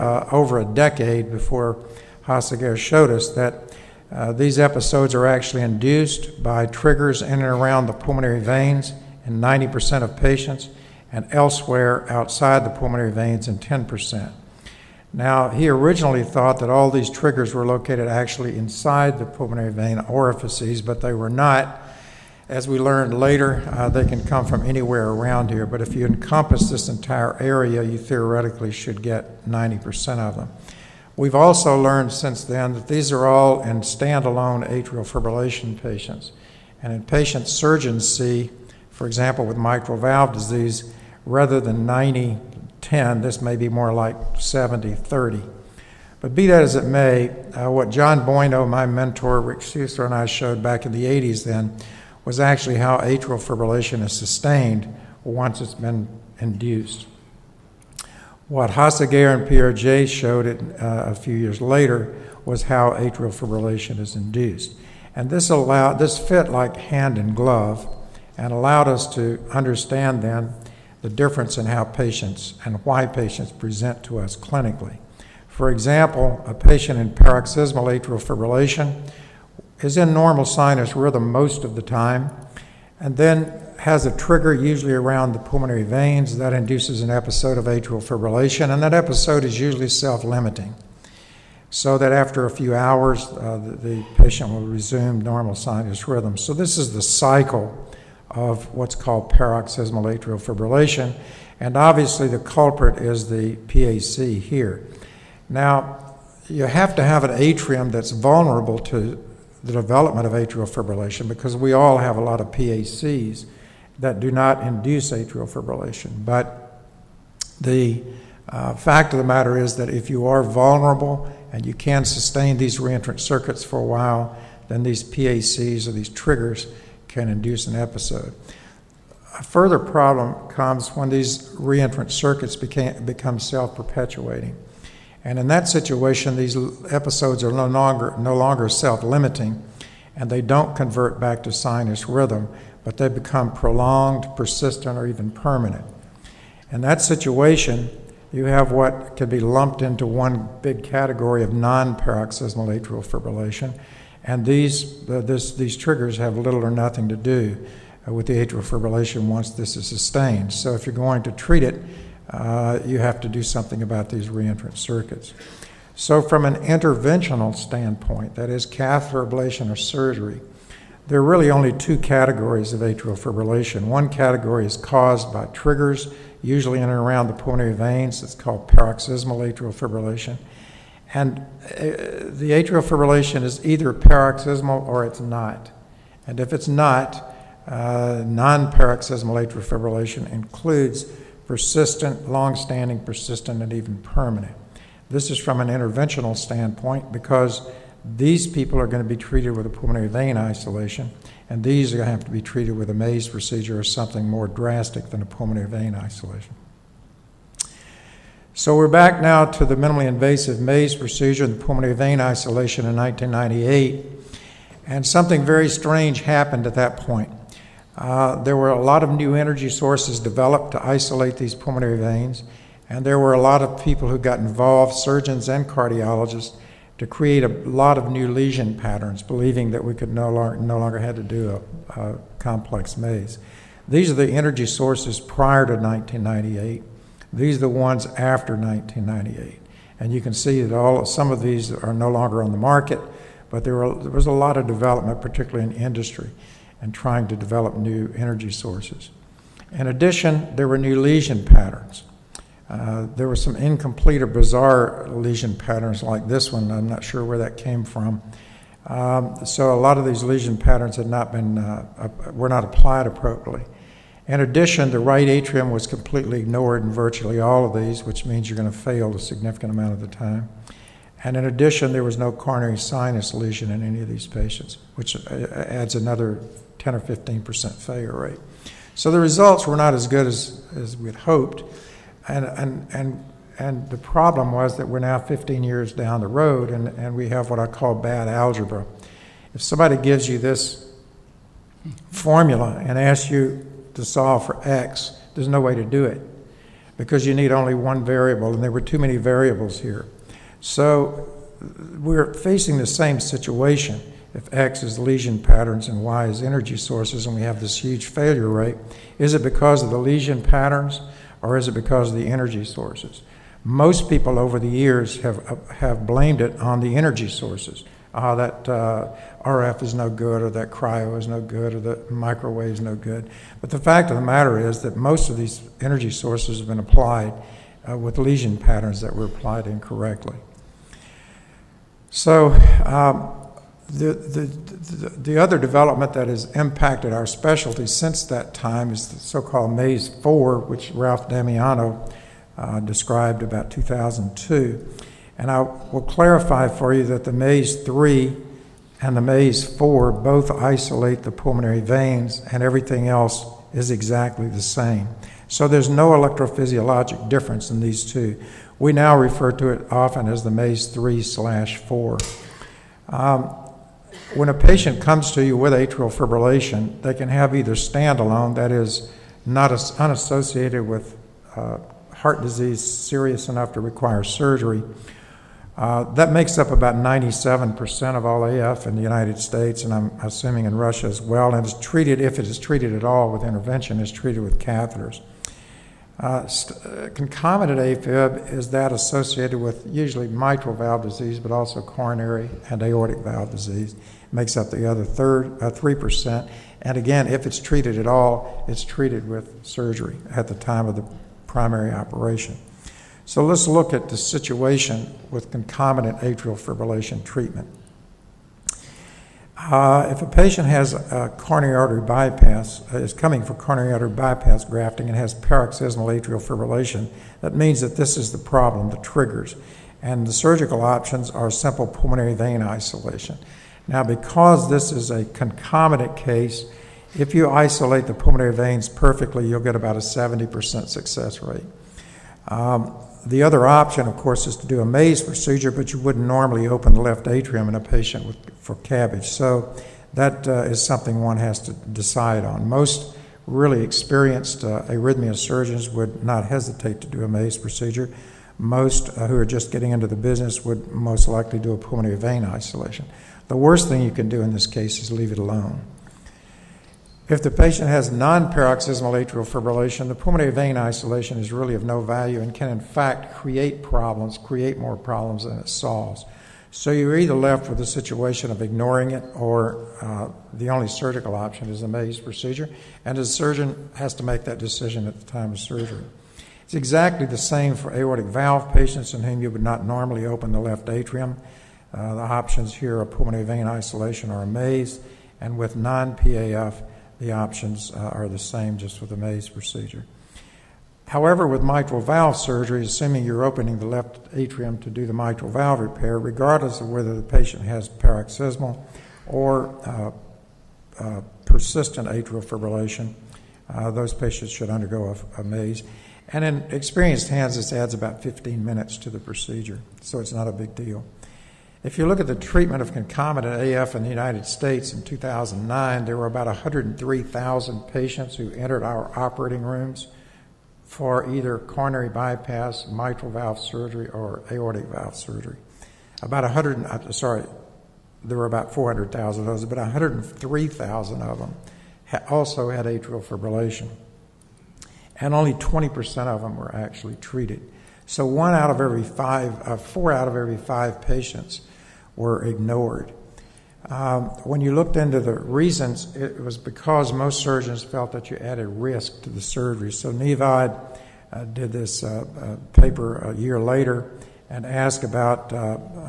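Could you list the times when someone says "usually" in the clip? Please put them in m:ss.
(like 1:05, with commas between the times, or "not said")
1:24, 1:29, 2:56, 6:29.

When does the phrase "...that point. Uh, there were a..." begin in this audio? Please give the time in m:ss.
3:36.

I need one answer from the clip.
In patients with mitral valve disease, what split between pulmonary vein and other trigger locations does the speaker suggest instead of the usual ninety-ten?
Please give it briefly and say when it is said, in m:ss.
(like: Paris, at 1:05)
70 30, at 0:44.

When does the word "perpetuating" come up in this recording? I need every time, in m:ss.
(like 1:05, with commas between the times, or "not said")
2:13.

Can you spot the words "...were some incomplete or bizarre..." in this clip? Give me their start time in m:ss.
4:13.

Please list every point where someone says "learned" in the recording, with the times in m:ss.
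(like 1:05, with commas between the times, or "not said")
0:22, 0:31.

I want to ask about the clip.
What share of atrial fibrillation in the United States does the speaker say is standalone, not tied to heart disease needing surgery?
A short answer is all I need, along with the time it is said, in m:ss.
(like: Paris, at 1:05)
97%, at 6:16.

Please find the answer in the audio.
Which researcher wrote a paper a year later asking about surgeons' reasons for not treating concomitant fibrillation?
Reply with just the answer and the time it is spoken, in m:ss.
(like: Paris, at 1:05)
Niv Ad, at 9:10.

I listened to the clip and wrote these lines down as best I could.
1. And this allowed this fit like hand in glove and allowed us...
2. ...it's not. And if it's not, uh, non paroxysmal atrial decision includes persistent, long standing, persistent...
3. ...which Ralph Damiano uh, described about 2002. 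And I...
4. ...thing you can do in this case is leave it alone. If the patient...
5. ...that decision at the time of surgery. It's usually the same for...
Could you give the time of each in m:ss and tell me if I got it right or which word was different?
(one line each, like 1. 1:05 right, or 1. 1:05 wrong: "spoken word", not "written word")
1. 1:05 right
2. 3:05 wrong: "fibrillation", not "decision"
3. 5:40 right
4. 7:33 right
5. 7:54 wrong: "exactly", not "usually".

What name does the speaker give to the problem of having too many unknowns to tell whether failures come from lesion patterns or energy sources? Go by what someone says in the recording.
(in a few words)
bad algebra.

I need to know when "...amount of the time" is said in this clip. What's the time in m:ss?
4:29.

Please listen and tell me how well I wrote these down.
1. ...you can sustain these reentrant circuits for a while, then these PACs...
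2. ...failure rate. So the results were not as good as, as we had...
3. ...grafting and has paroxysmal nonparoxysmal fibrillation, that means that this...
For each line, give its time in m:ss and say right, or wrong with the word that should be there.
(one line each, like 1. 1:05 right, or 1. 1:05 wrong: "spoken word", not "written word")
1. 2:01 right
2. 4:37 right
3. 6:54 wrong: "atrial", not "nonparoxysmal".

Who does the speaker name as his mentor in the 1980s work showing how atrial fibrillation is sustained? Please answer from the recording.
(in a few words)
John Boineau.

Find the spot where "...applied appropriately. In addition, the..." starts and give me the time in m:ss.
4:22.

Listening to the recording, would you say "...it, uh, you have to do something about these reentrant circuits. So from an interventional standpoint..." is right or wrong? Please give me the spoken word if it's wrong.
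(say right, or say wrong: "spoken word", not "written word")
right.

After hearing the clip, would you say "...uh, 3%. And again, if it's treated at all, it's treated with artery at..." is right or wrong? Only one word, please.
wrong.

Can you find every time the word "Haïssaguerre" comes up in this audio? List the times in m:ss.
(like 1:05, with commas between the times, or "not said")
0:02, 0:58.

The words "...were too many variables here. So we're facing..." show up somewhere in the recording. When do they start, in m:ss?
4:58.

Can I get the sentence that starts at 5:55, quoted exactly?
So there's no electrophysiologic difference in these two.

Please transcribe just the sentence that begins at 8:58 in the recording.
So one out of every five, uh, four out of every five patients were ignored.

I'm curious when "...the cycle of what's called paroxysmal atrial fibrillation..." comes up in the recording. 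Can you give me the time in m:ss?
1:36.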